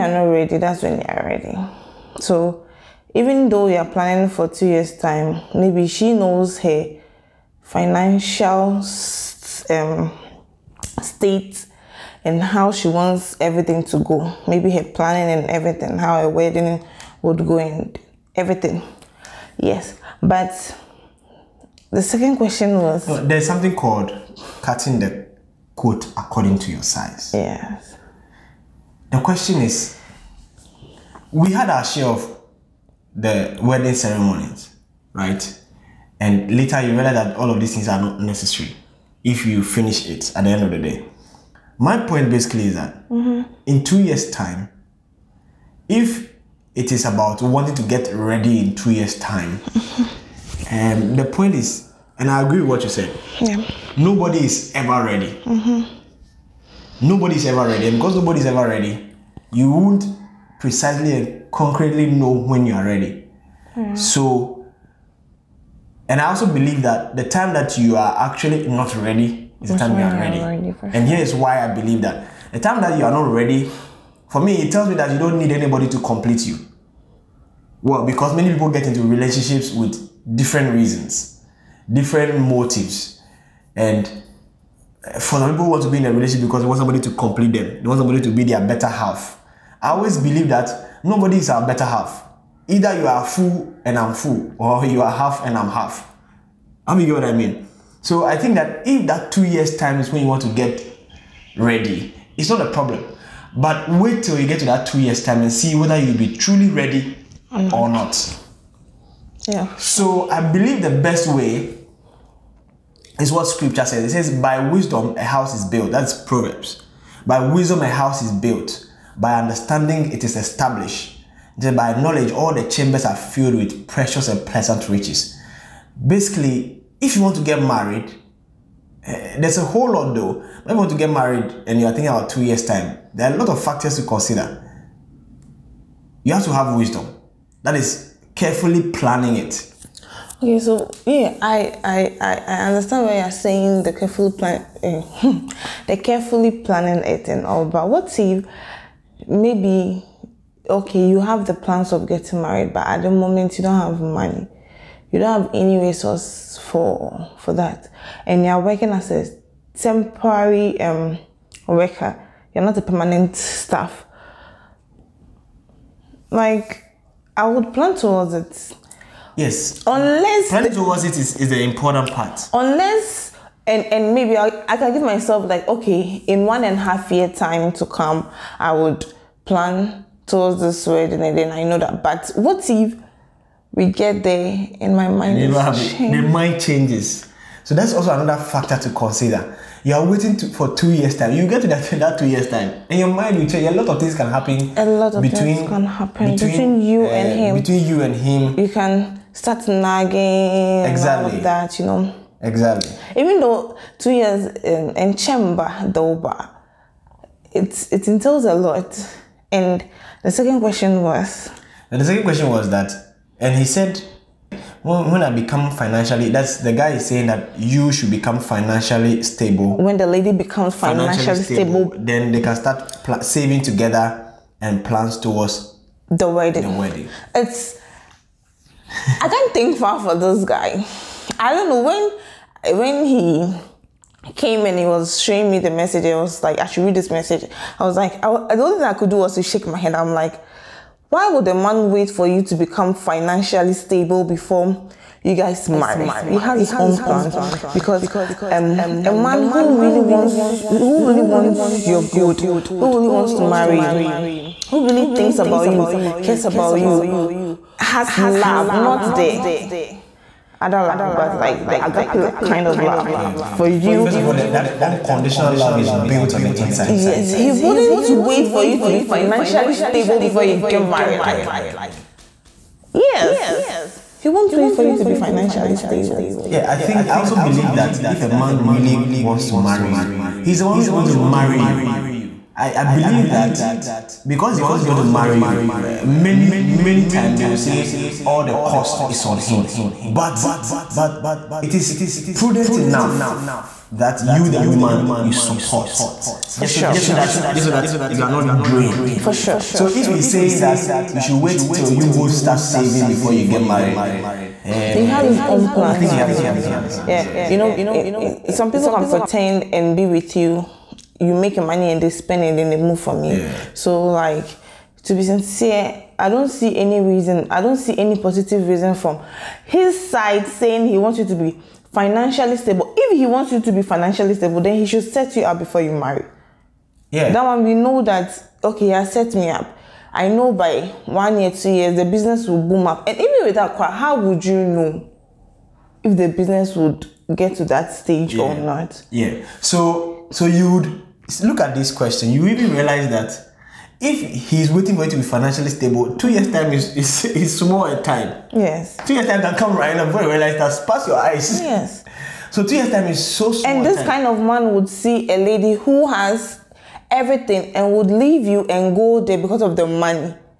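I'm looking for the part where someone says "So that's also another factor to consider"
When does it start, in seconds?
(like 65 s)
187 s.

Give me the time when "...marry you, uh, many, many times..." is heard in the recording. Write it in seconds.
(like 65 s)
285 s.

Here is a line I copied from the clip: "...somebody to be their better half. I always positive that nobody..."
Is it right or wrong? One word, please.
wrong.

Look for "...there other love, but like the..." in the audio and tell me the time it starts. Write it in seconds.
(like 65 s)
259 s.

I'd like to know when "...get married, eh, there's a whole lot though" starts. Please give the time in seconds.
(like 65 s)
127 s.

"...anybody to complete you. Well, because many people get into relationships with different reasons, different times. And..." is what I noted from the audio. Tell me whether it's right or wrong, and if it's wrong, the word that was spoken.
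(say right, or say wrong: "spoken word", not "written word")
wrong: "motives", not "times".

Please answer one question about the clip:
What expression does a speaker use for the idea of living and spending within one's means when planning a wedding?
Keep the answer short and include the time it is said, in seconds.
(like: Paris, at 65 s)
cutting the coat according to your size, at 24 s.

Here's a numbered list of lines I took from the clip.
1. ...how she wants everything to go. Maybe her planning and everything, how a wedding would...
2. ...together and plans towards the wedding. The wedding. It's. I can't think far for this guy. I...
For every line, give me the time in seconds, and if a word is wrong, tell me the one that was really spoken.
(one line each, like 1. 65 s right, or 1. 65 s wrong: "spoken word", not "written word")
1. 12 s right
2. 223 s right.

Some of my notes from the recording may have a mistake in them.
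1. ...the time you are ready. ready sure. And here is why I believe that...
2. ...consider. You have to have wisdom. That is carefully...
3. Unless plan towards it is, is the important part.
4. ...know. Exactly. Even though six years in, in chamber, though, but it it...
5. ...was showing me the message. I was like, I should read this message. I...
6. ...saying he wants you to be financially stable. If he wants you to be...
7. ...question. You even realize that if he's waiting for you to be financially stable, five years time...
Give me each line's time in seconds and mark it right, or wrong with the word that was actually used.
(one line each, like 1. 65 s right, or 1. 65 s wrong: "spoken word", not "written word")
1. 69 s right
2. 134 s right
3. 169 s right
4. 201 s wrong: "two", not "six"
5. 234 s right
6. 320 s right
7. 341 s wrong: "two", not "five".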